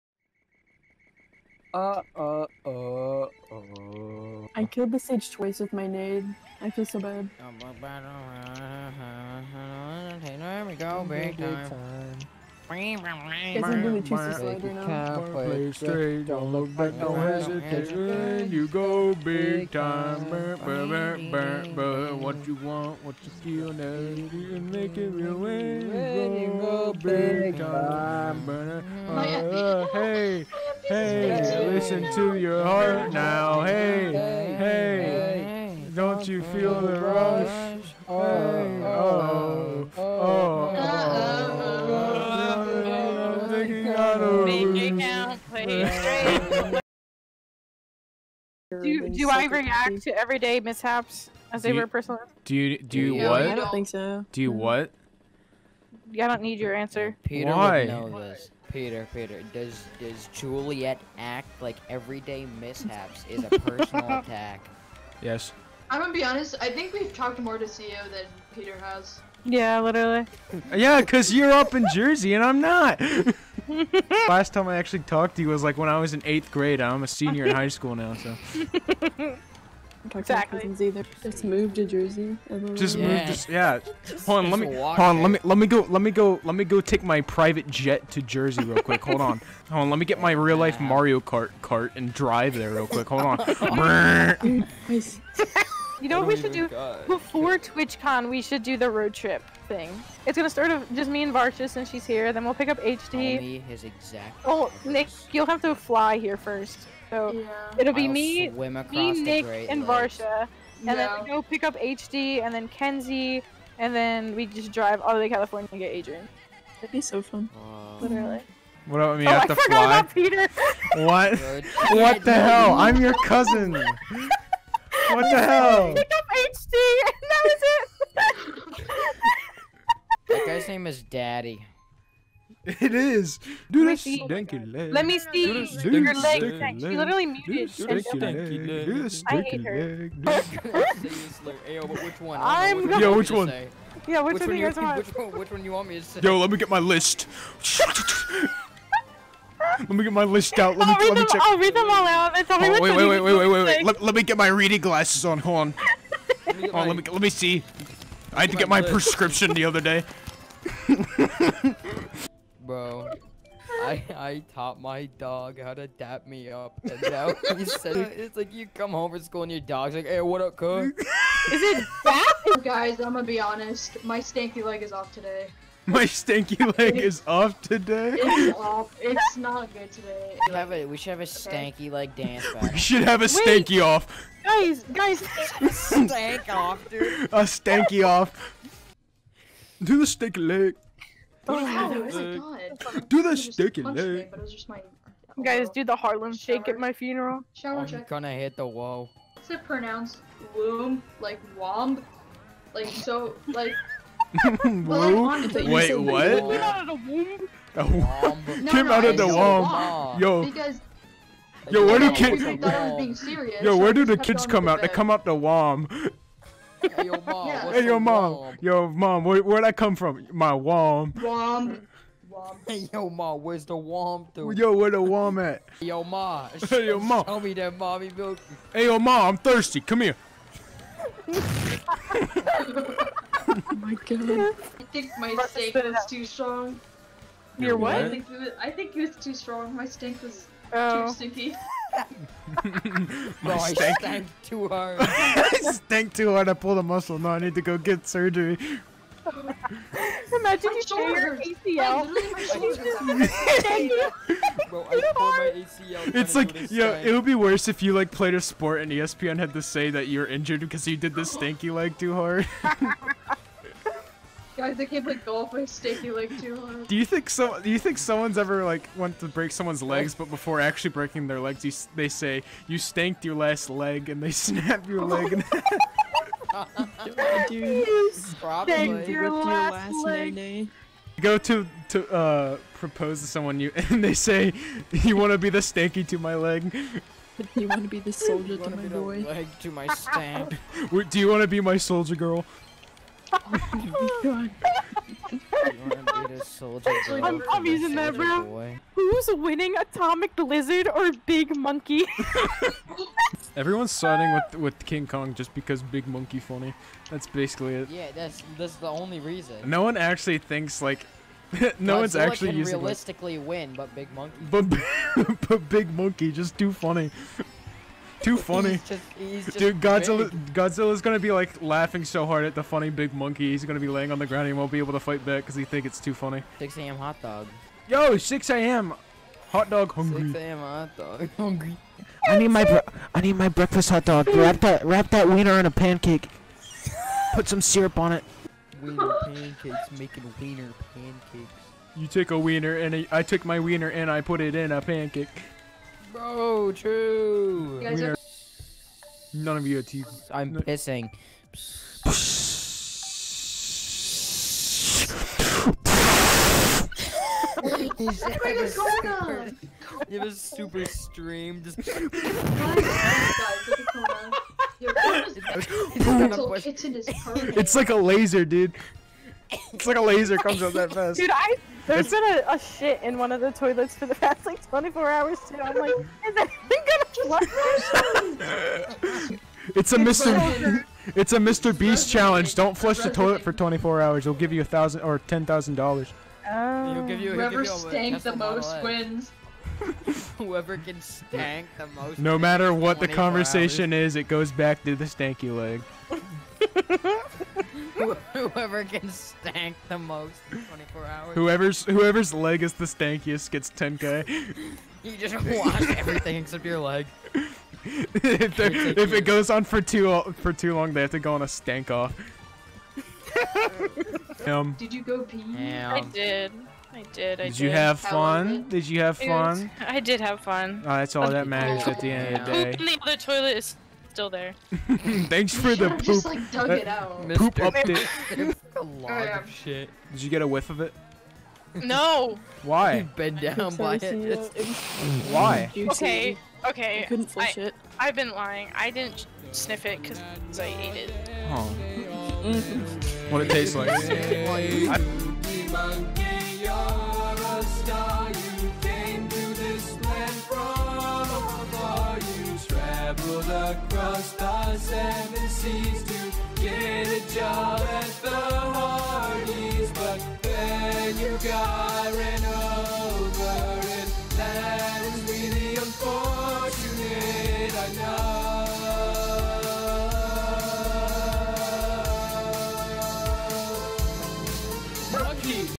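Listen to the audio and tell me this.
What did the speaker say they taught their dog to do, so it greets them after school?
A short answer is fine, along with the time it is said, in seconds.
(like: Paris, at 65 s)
dap me up, at 165 s.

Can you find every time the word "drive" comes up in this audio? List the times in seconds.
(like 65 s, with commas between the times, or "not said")
92 s, 114 s.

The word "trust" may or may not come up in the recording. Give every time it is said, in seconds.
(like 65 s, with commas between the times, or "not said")
not said.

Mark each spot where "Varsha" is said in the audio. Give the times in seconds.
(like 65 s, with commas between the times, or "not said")
101 s, 109 s.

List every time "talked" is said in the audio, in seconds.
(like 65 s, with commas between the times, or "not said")
67 s, 74 s.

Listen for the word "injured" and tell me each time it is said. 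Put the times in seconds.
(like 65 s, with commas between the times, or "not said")
260 s.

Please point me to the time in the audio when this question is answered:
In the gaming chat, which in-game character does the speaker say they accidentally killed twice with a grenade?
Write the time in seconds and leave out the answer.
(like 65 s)
4 s.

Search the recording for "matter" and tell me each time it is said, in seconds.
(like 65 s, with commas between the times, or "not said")
392 s, 421 s.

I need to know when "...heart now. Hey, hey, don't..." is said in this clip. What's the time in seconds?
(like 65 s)
32 s.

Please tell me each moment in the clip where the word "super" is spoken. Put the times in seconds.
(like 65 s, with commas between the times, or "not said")
360 s.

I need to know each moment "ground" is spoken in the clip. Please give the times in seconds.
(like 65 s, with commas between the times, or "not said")
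324 s.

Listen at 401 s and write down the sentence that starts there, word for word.
Whoever's whoever's leg is the stankiest gets 10k.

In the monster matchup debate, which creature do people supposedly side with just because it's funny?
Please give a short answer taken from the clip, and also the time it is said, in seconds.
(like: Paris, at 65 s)
King Kong, at 304 s.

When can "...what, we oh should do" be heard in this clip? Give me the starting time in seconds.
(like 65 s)
96 s.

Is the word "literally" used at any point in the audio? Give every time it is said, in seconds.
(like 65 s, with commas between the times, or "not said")
69 s, 118 s, 136 s.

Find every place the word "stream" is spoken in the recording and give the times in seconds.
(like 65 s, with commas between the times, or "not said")
360 s.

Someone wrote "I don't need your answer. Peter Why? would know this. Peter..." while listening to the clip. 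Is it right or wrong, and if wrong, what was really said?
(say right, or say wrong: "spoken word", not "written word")
right.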